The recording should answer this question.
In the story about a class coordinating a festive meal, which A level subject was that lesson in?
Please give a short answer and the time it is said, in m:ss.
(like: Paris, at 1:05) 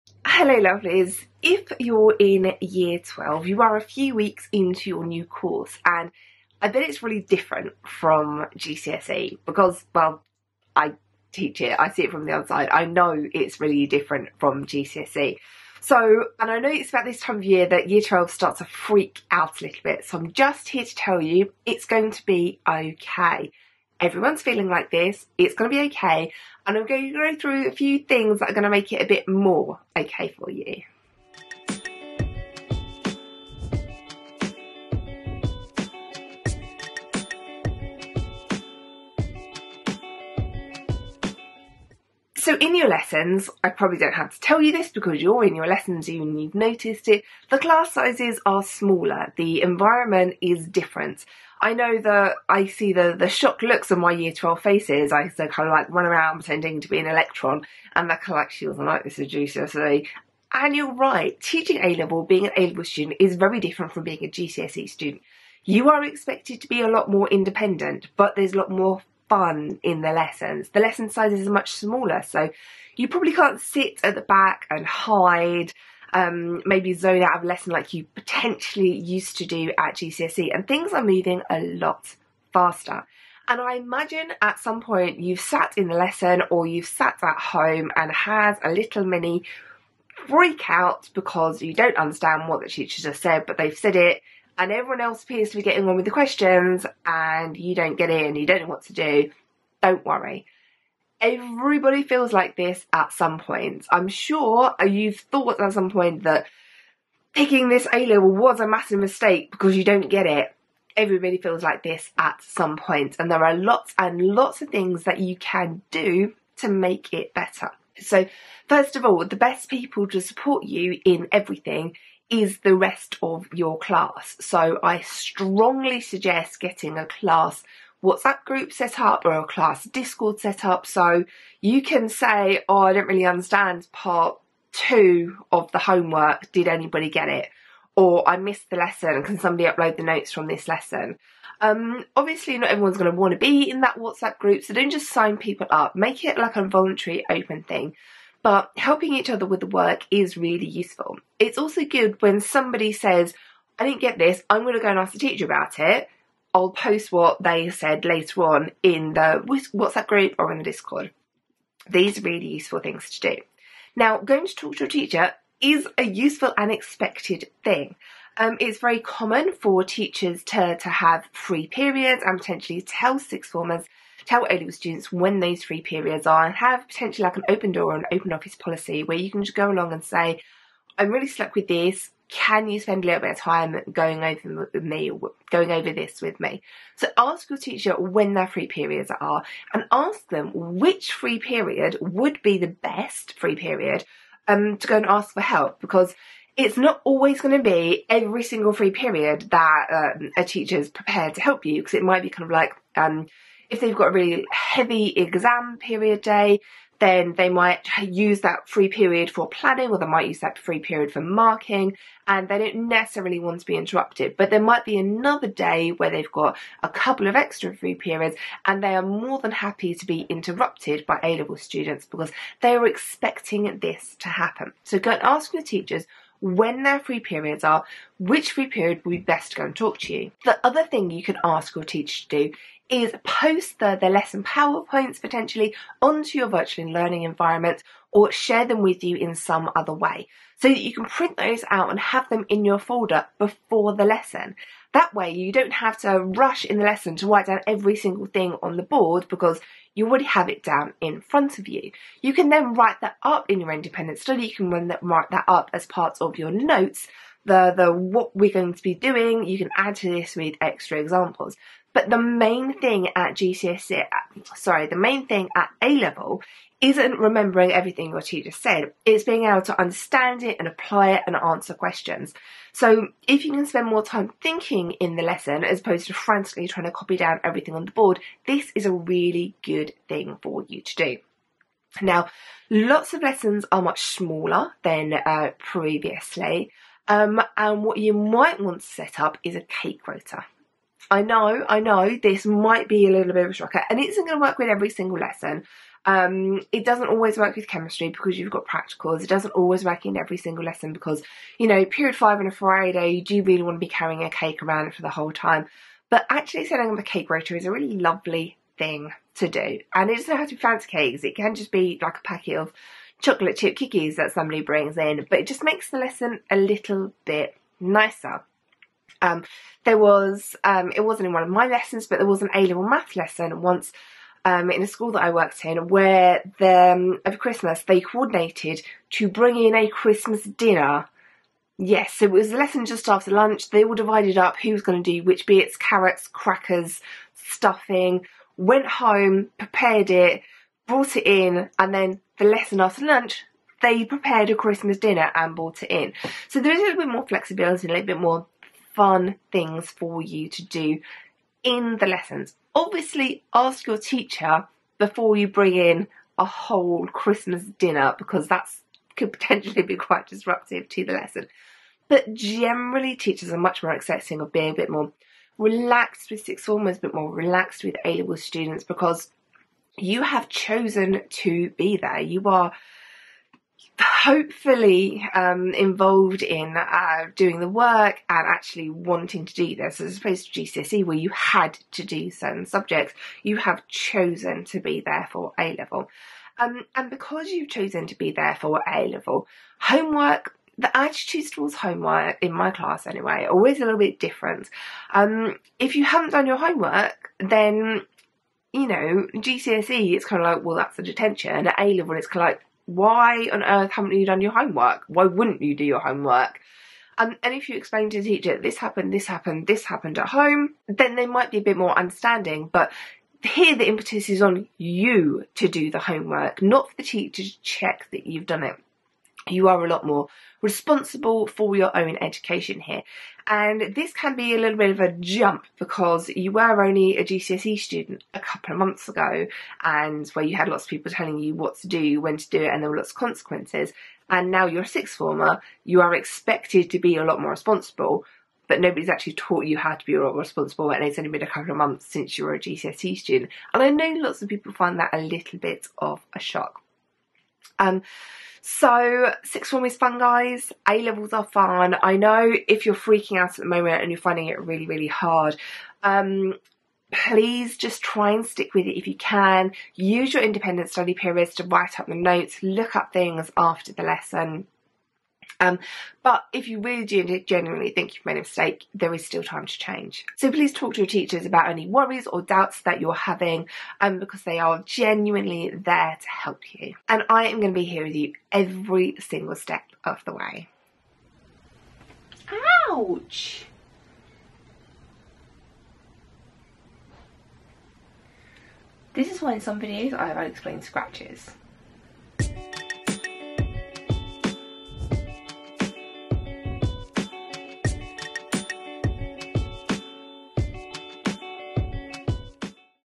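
math, at 5:22.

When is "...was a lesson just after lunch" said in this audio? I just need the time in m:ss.
5:32.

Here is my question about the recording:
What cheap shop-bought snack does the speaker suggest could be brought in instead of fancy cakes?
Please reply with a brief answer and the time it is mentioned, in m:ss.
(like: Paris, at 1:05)
chocolate chip cookies, at 5:13.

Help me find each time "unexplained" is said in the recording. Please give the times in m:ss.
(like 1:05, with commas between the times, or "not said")
8:10.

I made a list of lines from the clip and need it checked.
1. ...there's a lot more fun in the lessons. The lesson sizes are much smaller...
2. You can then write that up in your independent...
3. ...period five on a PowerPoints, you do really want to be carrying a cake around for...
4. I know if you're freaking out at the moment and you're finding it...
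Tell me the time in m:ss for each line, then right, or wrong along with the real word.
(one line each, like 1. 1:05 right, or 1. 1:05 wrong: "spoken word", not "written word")
1. 1:08 right
2. 4:12 right
3. 5:01 wrong: "Friday", not "PowerPoints"
4. 7:32 right.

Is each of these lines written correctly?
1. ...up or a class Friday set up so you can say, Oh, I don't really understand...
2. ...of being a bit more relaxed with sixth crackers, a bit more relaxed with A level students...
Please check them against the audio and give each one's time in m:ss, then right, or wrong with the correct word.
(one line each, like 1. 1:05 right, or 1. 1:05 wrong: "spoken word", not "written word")
1. 2:08 wrong: "Discord", not "Friday"
2. 6:04 wrong: "formers", not "crackers".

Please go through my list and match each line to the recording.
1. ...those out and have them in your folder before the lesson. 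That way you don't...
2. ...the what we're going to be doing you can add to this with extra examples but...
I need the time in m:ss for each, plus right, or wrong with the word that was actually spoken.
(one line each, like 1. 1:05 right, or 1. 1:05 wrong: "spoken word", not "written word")
1. 4:01 right
2. 4:17 right.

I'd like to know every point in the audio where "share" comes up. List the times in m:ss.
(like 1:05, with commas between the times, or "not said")
3:58.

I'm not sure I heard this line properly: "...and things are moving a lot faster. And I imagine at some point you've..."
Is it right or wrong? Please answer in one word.
right.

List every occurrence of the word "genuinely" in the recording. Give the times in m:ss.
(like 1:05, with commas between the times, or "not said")
7:47, 7:54.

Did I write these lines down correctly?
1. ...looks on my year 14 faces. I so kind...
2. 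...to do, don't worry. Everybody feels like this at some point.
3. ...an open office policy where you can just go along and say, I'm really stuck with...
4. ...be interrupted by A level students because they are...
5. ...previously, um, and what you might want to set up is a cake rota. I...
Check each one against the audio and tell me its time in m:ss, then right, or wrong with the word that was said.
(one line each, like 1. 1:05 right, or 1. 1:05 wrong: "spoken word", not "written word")
1. 0:53 wrong: "12", not "14"
2. 1:38 right
3. 2:57 right
4. 3:40 right
5. 4:45 right.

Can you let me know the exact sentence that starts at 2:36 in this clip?
I'll post what they said later on in the WhatsApp group or in the Discord.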